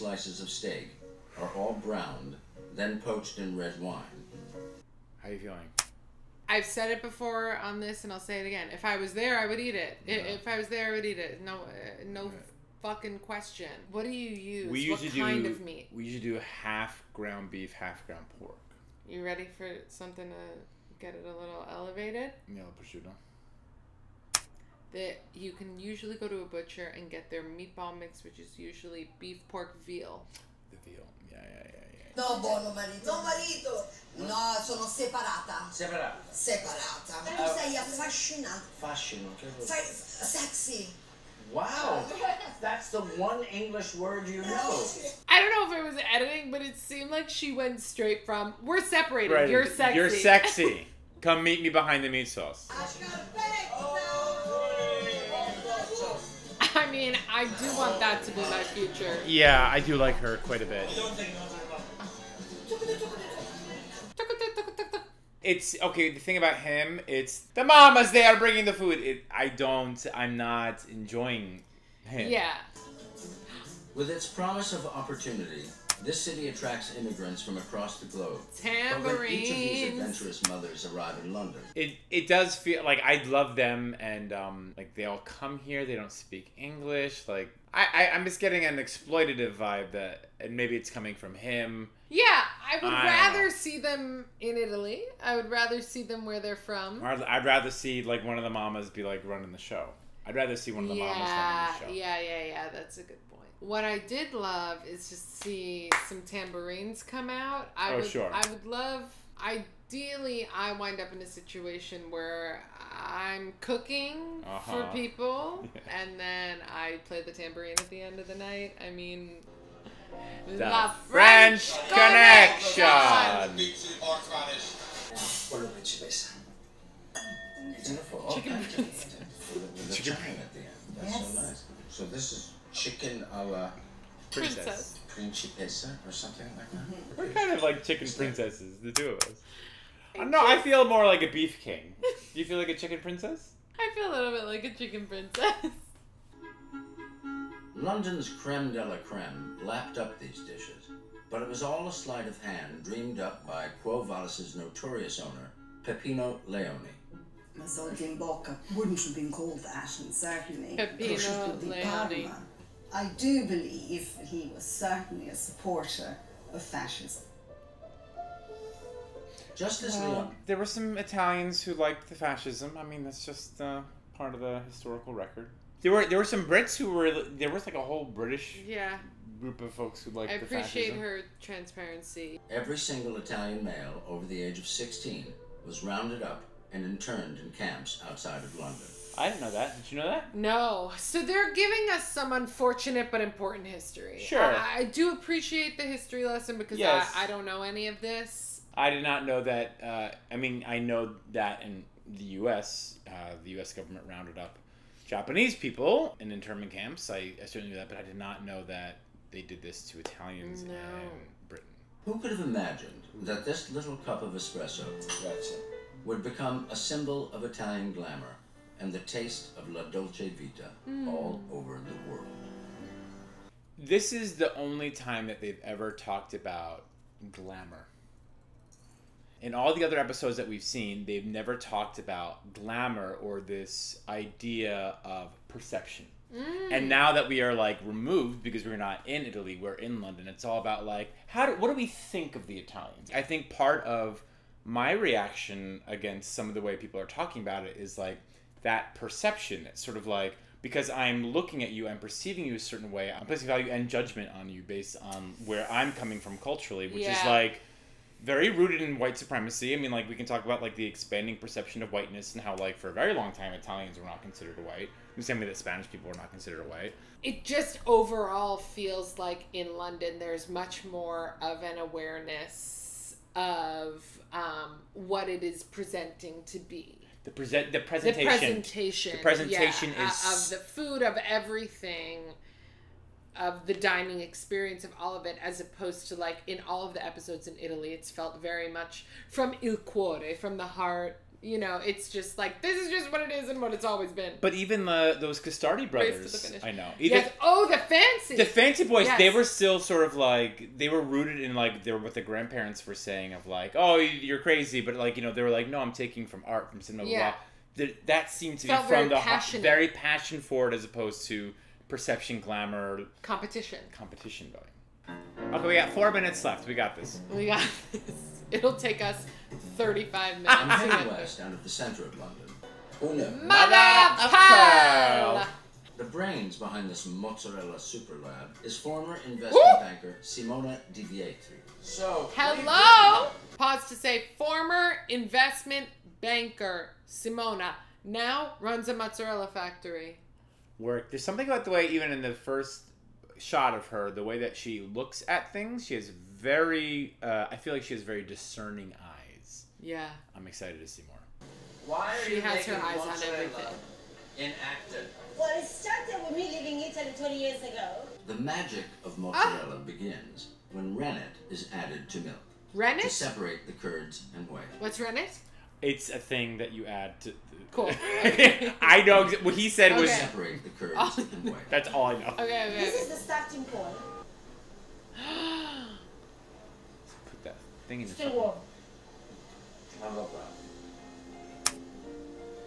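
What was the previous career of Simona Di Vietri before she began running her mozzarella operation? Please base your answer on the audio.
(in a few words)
Investment banker.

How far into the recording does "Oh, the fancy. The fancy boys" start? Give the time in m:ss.
4:57.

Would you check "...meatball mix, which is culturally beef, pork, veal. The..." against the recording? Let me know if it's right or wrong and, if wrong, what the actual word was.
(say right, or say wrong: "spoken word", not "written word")
wrong: "usually", not "culturally".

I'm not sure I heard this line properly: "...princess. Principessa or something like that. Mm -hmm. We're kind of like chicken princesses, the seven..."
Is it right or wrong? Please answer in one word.
wrong.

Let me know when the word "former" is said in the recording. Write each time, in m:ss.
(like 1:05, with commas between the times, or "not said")
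5:28, 5:34.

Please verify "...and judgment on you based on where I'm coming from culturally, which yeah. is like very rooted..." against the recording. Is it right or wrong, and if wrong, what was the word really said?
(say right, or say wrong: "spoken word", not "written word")
right.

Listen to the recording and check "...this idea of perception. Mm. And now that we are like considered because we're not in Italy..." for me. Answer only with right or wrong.
wrong.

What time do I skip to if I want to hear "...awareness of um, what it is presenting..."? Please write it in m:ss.
4:31.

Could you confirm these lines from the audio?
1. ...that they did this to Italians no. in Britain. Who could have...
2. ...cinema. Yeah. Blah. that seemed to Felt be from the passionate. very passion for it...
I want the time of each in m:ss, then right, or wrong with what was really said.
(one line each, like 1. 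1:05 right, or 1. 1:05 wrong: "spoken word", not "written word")
1. 3:28 right
2. 5:06 right.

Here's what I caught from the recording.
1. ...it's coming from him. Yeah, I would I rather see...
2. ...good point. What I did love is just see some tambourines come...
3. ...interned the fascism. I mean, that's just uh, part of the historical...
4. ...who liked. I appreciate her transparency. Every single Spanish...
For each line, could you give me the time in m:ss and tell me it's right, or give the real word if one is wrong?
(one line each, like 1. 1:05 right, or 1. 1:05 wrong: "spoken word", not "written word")
1. 1:30 right
2. 1:43 right
3. 2:51 wrong: "liked", not "interned"
4. 3:00 wrong: "Italian", not "Spanish".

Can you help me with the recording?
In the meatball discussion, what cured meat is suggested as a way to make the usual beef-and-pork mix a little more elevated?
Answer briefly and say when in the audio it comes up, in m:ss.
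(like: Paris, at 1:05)
Prosciutto, at 0:22.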